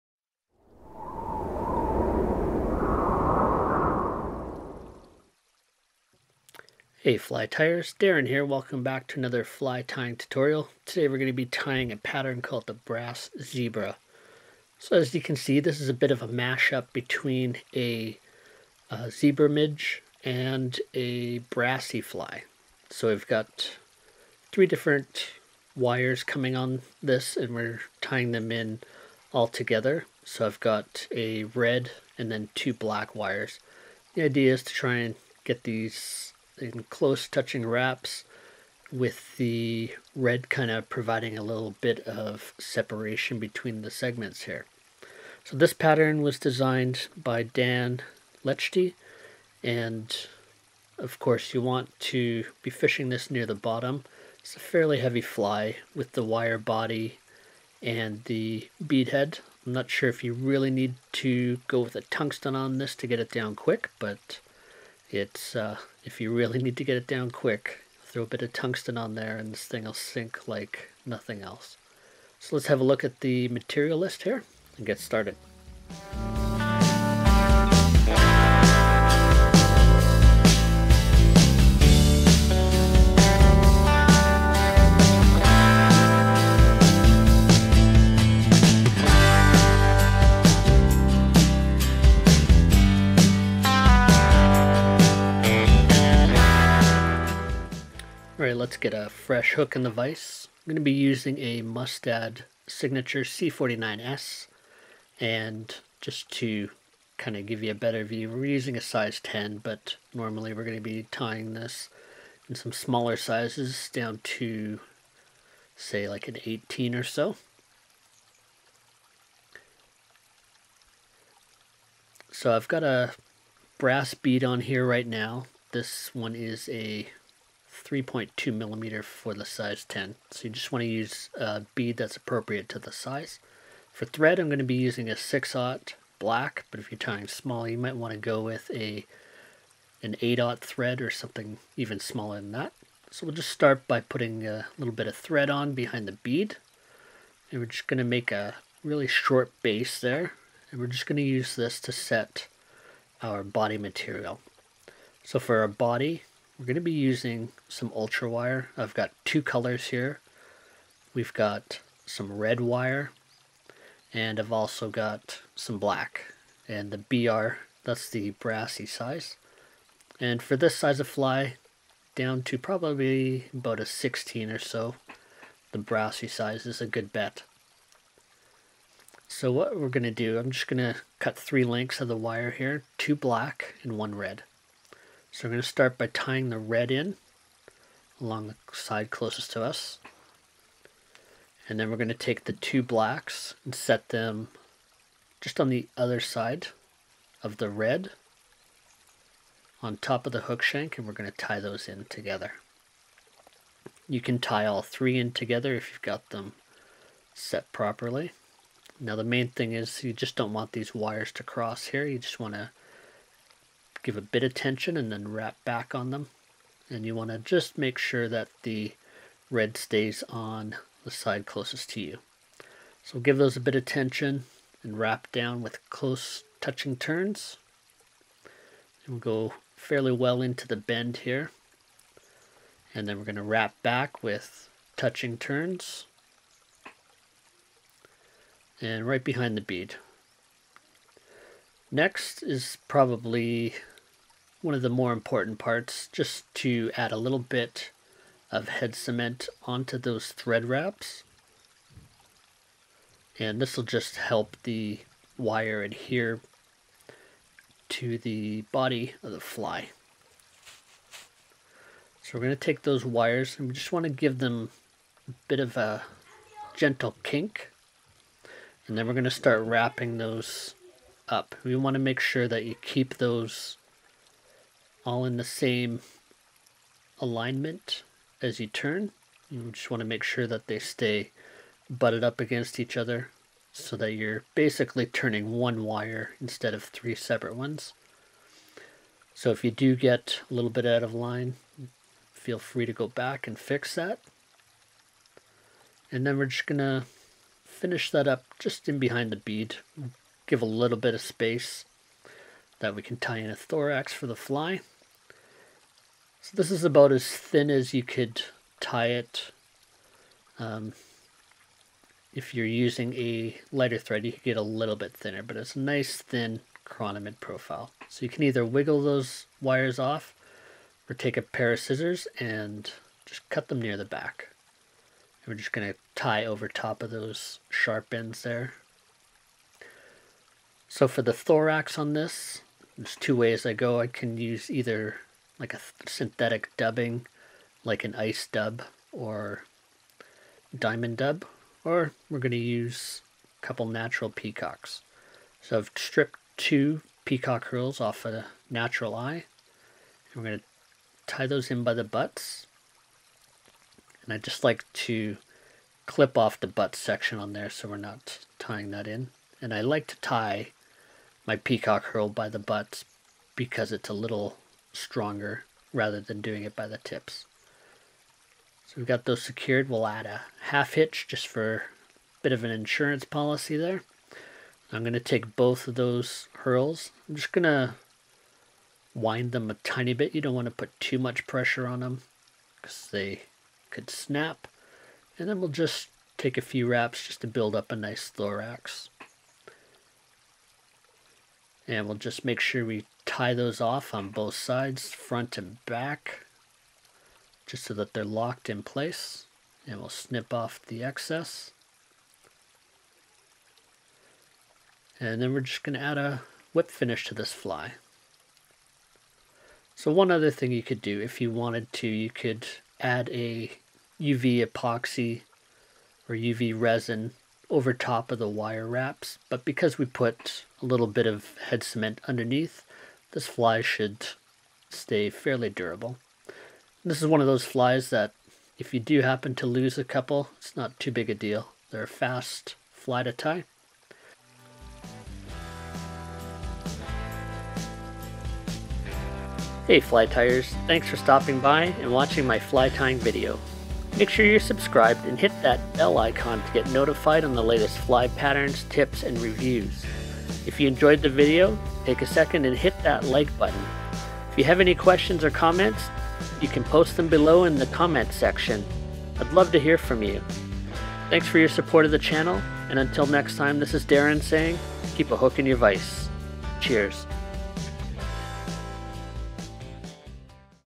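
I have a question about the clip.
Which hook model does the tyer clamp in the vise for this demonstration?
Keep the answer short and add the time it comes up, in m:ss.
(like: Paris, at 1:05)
Mustad Signature C49S, at 1:41.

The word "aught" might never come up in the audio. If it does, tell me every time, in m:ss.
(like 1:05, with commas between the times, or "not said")
2:15, 2:20.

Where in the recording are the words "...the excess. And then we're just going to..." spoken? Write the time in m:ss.
6:40.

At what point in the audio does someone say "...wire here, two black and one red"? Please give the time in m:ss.
3:02.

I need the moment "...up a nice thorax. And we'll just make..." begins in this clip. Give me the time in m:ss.
6:27.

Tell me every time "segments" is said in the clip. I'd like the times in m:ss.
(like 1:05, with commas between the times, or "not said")
0:43.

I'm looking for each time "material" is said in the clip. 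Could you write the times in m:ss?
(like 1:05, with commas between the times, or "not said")
1:13, 2:33.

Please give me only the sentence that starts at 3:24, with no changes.
You can tie all three in together if you've got them set properly.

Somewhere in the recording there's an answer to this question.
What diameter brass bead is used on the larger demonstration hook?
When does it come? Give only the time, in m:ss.
2:07.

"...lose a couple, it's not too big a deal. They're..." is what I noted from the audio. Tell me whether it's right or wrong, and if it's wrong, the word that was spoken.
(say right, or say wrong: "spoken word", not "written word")
right.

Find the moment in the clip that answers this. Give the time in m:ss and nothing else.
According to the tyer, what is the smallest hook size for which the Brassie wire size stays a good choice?
2:53.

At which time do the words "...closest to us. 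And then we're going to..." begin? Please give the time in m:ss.
3:09.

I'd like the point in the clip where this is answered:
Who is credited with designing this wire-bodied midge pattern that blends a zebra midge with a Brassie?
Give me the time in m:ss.
0:47.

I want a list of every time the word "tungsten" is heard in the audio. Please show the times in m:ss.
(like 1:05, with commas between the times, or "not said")
1:02, 1:08.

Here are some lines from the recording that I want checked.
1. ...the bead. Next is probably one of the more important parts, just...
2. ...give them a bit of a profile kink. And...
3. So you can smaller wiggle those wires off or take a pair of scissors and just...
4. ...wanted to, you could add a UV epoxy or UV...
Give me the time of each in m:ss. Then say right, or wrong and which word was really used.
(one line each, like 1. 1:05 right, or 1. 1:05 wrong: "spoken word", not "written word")
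1. 3:59 right
2. 4:24 wrong: "gentle", not "profile"
3. 5:18 wrong: "either", not "smaller"
4. 6:51 right.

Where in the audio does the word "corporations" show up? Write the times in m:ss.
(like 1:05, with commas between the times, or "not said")
not said.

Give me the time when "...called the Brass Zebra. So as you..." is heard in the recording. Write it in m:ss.
0:12.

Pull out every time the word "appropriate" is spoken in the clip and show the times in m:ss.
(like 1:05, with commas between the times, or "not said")
2:12.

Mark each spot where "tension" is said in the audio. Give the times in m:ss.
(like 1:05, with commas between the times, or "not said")
3:34, 3:43.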